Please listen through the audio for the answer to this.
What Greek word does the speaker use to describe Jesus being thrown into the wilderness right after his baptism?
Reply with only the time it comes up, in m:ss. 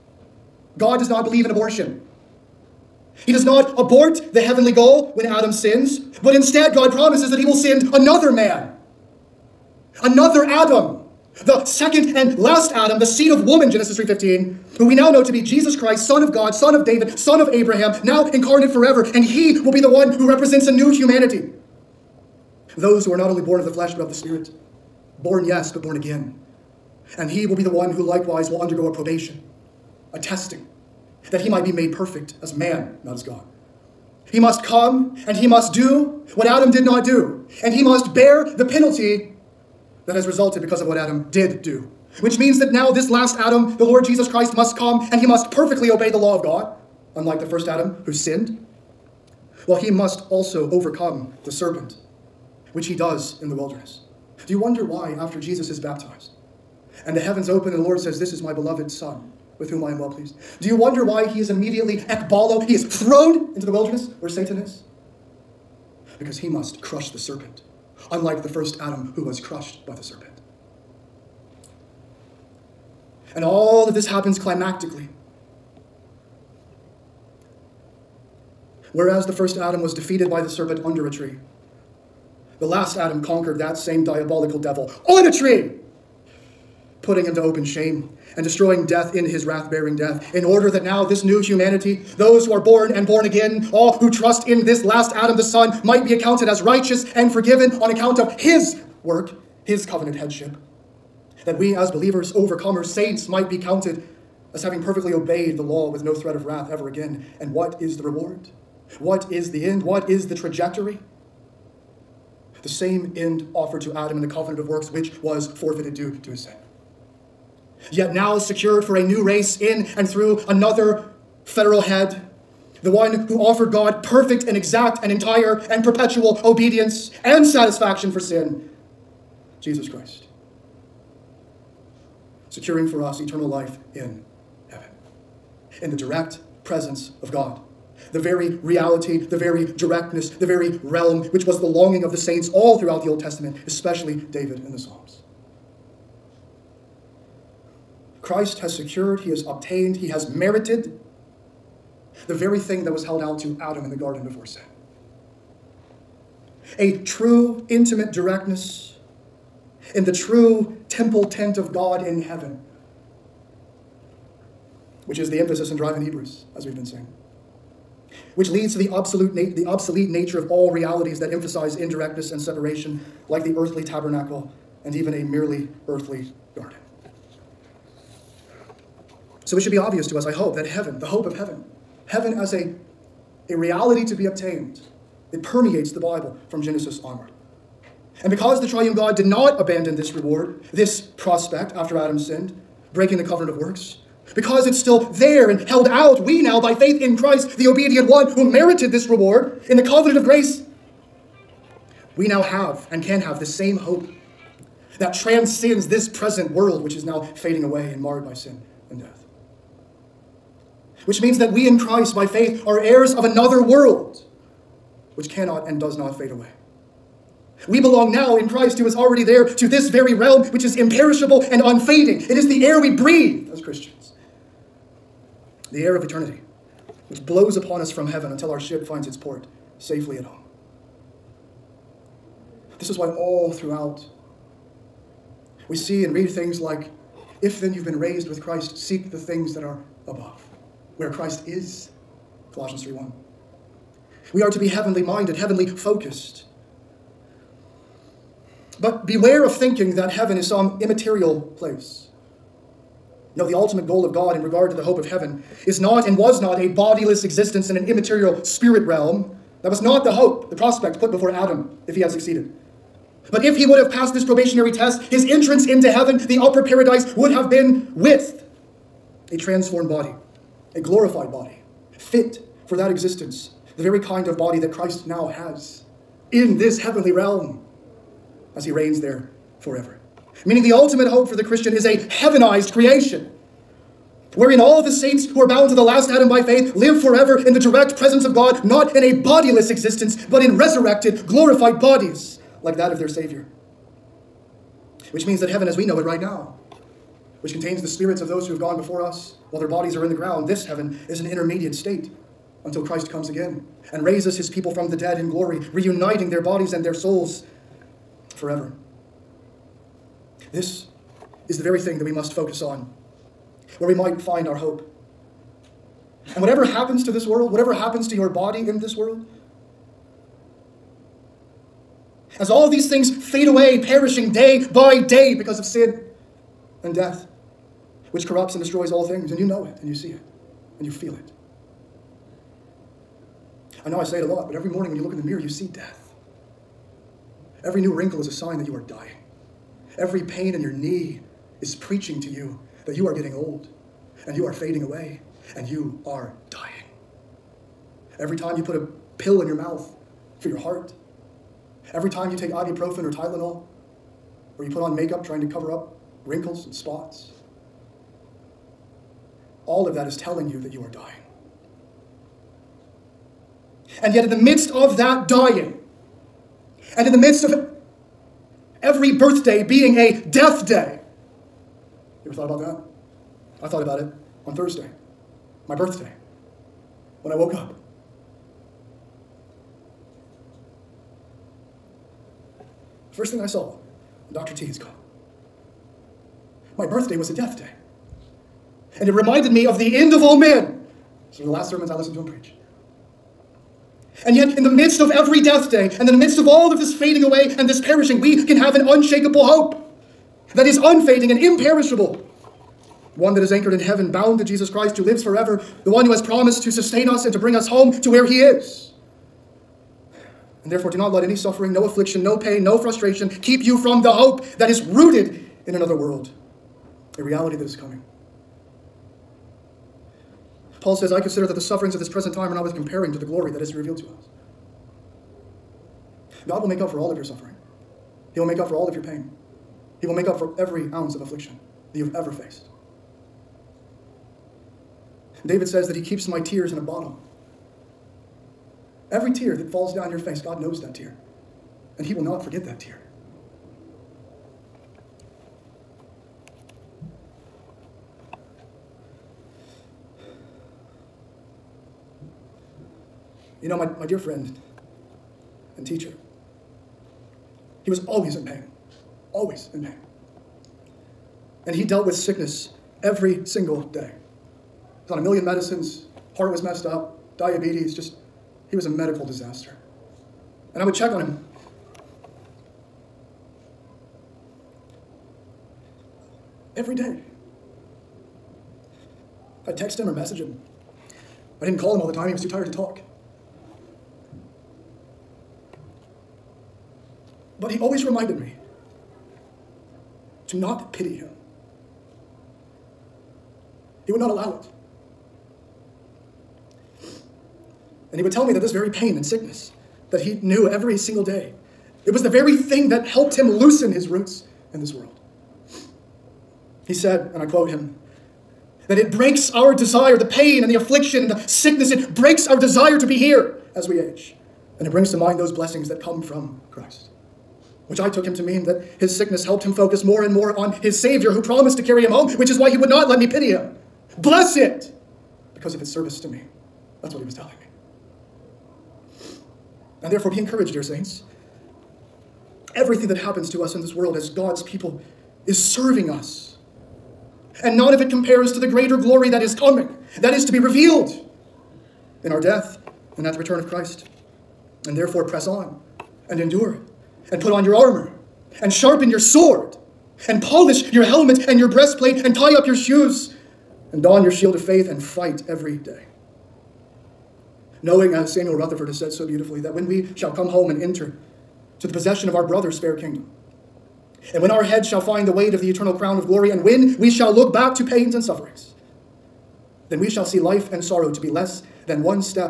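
1:01.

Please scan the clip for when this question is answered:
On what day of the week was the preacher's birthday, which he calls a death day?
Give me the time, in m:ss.
6:14.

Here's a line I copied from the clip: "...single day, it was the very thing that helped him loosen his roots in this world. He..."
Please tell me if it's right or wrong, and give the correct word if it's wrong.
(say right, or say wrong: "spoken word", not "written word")
right.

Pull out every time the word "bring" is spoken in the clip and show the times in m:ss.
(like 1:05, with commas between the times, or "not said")
6:47, 8:34.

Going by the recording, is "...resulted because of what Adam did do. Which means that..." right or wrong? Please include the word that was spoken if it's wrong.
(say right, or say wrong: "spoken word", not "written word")
right.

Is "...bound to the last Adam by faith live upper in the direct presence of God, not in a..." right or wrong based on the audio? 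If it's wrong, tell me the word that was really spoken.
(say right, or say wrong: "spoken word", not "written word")
wrong: "forever", not "upper".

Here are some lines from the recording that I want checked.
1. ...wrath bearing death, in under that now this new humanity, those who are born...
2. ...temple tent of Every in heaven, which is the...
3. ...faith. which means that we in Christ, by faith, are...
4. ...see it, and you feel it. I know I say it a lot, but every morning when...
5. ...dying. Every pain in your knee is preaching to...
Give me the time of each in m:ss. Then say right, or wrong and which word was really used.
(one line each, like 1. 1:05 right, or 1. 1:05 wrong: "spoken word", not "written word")
1. 1:29 wrong: "order", not "under"
2. 2:40 wrong: "God", not "Every"
3. 3:28 wrong: "death", not "faith"
4. 5:29 right
5. 5:38 right.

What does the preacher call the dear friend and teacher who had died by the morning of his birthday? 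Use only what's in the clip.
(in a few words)
Dr. T.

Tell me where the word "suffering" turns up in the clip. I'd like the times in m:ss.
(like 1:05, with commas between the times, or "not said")
6:51, 7:01, 7:07, 9:28.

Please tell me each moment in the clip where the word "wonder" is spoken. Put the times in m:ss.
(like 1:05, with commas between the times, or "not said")
0:54, 1:00.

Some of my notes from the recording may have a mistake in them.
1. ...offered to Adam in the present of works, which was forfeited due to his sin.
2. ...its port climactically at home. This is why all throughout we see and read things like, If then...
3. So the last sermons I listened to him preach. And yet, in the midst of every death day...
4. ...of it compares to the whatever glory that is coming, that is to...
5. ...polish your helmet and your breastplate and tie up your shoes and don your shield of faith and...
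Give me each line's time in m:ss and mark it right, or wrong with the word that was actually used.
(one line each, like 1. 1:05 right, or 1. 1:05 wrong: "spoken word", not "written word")
1. 1:53 wrong: "covenant", not "present"
2. 3:49 wrong: "safely", not "climactically"
3. 6:31 right
4. 8:57 wrong: "greater", not "whatever"
5. 9:10 right.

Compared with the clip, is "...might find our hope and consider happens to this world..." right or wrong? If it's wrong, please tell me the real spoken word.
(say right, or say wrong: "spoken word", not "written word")
wrong: "whatever", not "consider".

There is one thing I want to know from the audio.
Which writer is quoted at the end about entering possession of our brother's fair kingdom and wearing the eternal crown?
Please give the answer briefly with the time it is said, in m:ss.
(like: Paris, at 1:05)
Samuel Rutherford, at 9:18.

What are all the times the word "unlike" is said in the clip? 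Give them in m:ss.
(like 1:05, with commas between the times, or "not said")
0:47, 1:08.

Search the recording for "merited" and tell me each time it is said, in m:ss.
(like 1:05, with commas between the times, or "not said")
2:30, 3:18.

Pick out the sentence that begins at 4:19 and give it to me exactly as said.
That was not the hope, the prospect put before Adam if he had succeeded.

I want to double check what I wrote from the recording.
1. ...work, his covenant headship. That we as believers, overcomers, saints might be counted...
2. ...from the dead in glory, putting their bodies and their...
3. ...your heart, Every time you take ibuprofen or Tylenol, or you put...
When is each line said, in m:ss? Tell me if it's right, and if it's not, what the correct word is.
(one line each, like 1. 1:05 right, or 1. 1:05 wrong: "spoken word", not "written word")
1. 1:39 right
2. 5:04 wrong: "reuniting", not "putting"
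3. 5:50 right.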